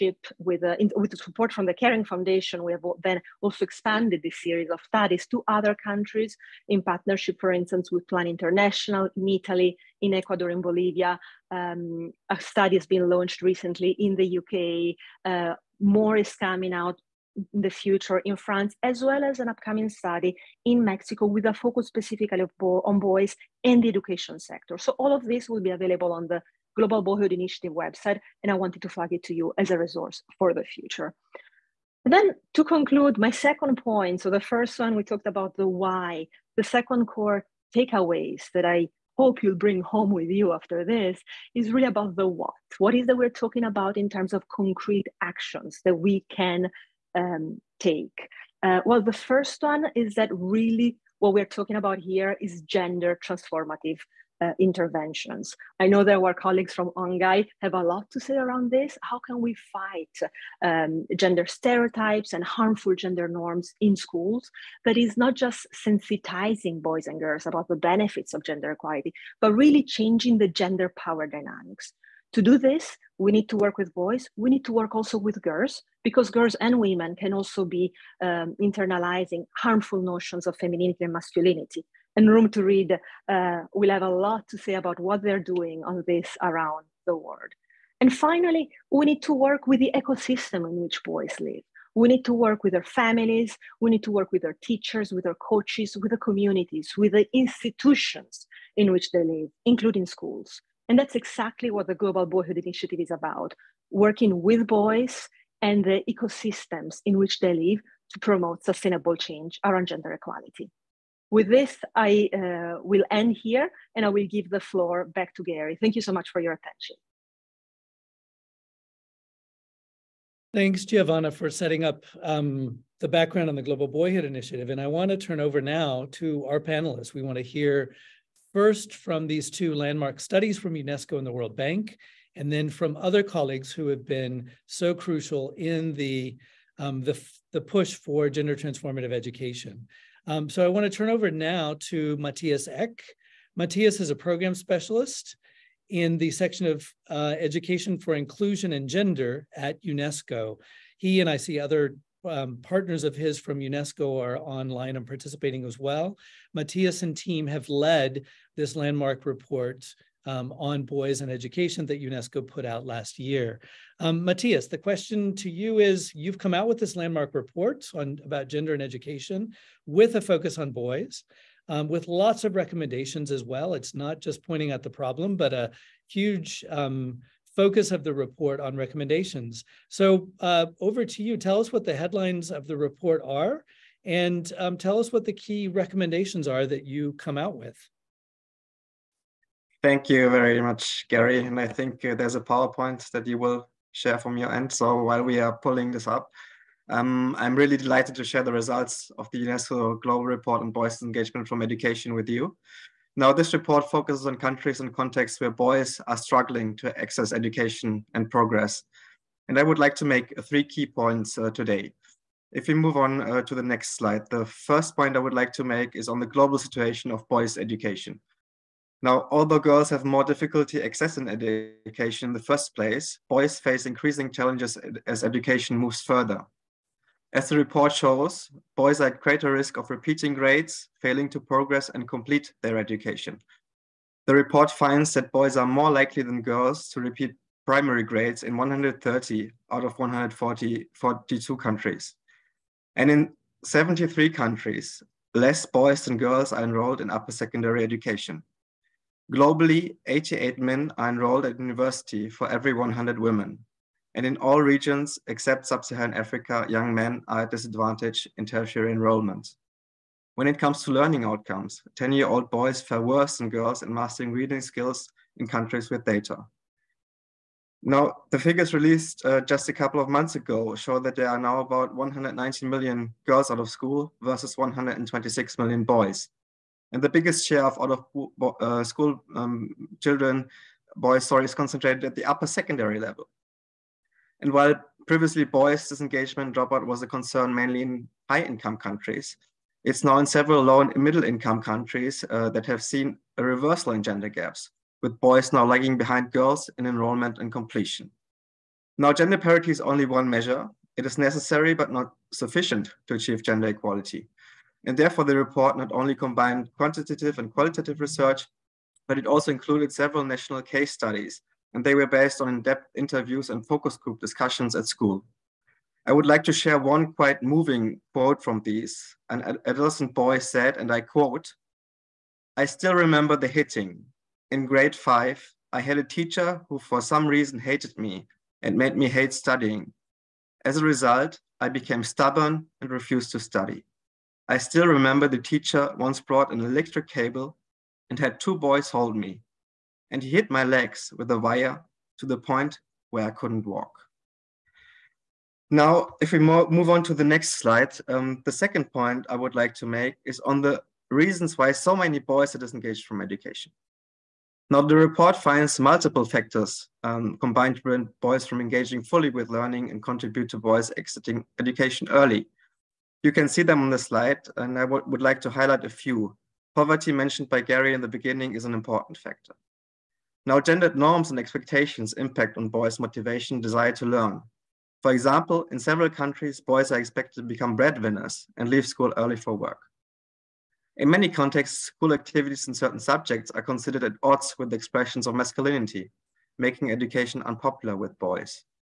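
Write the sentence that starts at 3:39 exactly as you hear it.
Now, although girls have more difficulty accessing education in the first place, boys face increasing challenges as education moves further.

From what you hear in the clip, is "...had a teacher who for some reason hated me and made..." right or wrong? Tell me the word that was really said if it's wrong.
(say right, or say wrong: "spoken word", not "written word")
right.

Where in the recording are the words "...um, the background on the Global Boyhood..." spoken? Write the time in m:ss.
2:02.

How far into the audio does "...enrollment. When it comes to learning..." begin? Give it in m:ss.
4:18.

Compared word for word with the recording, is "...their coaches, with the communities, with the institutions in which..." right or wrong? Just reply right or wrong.
right.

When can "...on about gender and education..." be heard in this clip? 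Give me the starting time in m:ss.
2:47.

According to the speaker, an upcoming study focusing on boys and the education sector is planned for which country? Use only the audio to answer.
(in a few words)
Mexico.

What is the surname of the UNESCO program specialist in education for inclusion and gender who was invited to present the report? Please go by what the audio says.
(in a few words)
Eck.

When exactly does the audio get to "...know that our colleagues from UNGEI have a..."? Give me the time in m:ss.
0:55.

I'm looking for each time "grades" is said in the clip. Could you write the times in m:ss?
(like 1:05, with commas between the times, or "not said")
3:50, 3:58, 5:24.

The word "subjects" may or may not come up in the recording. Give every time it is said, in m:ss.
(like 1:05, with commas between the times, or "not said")
6:23.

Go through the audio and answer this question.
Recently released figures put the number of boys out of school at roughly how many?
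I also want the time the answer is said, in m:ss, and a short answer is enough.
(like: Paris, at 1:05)
126 million, at 4:34.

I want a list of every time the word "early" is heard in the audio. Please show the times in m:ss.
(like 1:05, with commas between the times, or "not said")
6:02, 6:19.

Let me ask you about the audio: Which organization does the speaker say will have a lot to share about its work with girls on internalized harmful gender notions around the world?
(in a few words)
Room to Read.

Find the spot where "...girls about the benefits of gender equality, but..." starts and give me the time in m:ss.
1:07.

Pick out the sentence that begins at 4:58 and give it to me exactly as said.
Now, gender parity is only one measure.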